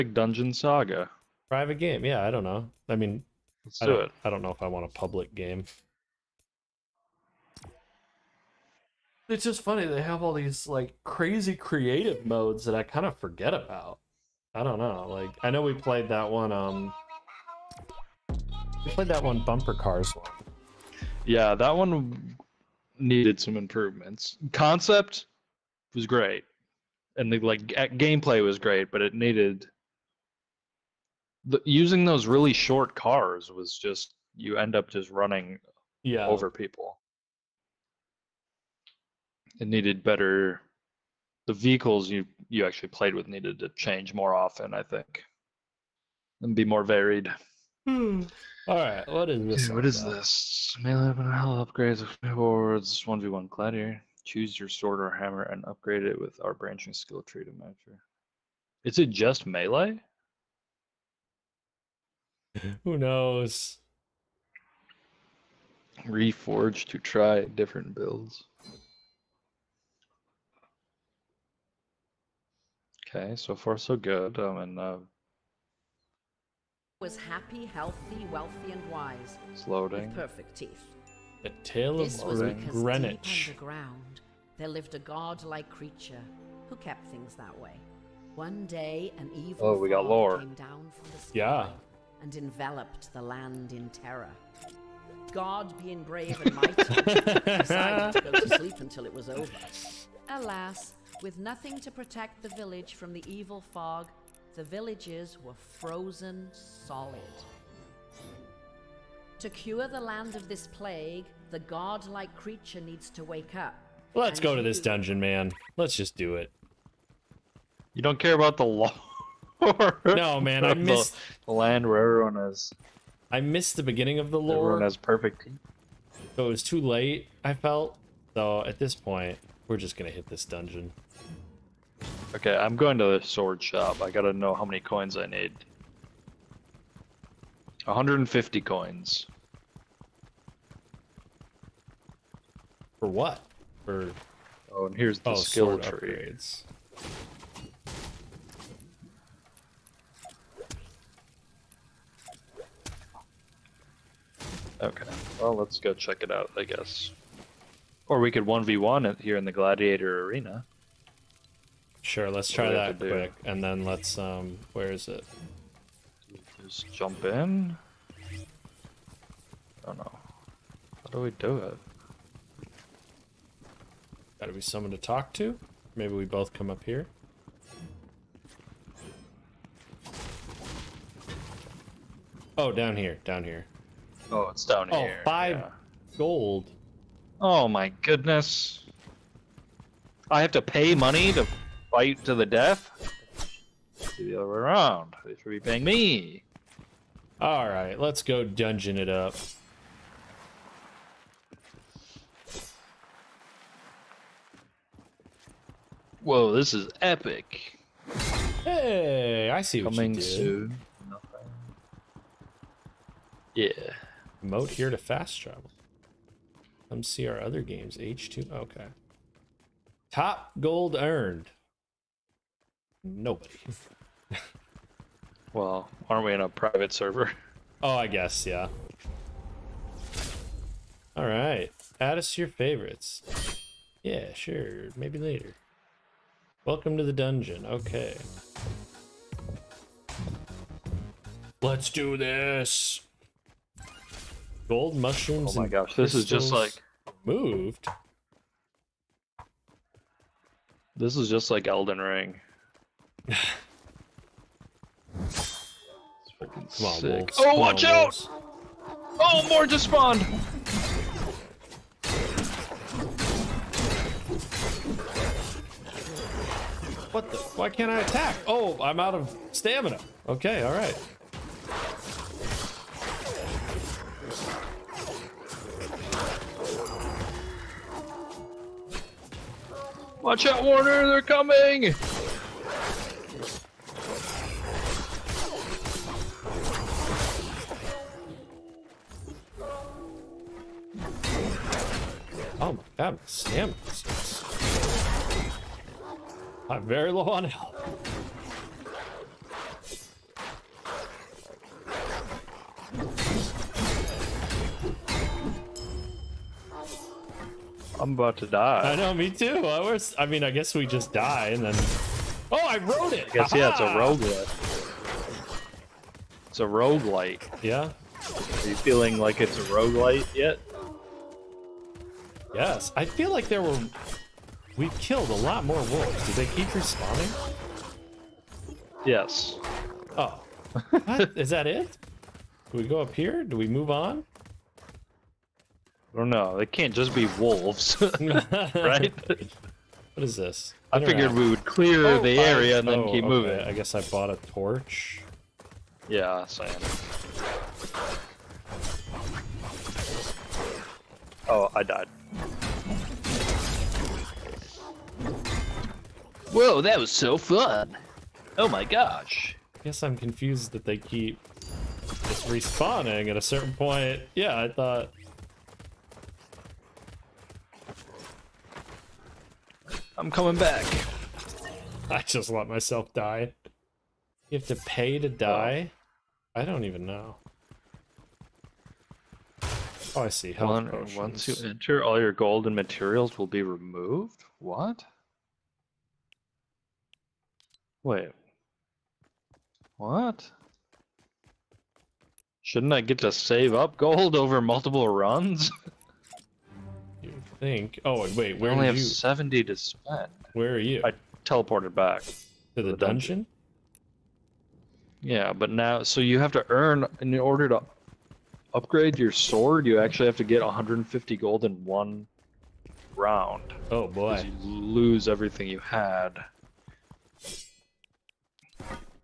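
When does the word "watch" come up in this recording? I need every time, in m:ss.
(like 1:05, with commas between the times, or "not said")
4:17, 4:40.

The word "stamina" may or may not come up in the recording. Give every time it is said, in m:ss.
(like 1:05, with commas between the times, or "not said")
4:29, 4:53.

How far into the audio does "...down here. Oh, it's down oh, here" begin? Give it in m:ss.
3:03.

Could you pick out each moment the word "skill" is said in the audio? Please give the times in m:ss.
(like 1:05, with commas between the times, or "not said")
0:56, 2:25.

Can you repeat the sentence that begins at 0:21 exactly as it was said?
Yeah, that one needed some improvements.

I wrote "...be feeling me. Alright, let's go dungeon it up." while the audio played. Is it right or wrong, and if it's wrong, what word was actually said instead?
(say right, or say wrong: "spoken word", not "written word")
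wrong: "paying", not "feeling".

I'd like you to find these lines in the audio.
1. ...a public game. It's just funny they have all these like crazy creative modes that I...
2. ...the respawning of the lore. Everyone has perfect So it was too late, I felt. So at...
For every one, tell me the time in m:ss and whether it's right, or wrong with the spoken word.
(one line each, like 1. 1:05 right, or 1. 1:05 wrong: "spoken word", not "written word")
1. 0:04 right
2. 2:03 wrong: "beginning", not "respawning".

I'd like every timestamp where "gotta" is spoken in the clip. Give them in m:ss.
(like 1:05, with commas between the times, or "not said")
2:14, 2:54.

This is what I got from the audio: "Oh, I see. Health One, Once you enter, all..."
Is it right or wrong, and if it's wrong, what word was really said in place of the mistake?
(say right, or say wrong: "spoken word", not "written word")
right.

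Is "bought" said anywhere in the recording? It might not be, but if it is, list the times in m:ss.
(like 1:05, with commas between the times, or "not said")
5:44.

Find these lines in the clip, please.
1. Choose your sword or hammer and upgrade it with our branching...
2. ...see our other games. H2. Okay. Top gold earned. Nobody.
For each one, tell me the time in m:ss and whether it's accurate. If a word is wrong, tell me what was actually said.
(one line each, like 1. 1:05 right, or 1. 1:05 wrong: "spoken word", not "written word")
1. 0:54 right
2. 3:37 right.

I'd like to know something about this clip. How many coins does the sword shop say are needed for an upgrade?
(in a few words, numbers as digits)
150.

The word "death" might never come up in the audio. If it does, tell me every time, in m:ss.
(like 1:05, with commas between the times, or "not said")
3:12.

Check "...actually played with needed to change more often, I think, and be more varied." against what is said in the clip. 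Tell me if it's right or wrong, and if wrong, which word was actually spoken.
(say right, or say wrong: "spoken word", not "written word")
right.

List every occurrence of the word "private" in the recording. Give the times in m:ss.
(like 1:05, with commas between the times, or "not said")
0:01, 3:46.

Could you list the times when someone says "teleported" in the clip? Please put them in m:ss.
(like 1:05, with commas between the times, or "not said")
6:41.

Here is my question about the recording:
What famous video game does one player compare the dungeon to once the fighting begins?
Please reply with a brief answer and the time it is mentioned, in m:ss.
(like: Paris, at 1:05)
Elden Ring, at 4:11.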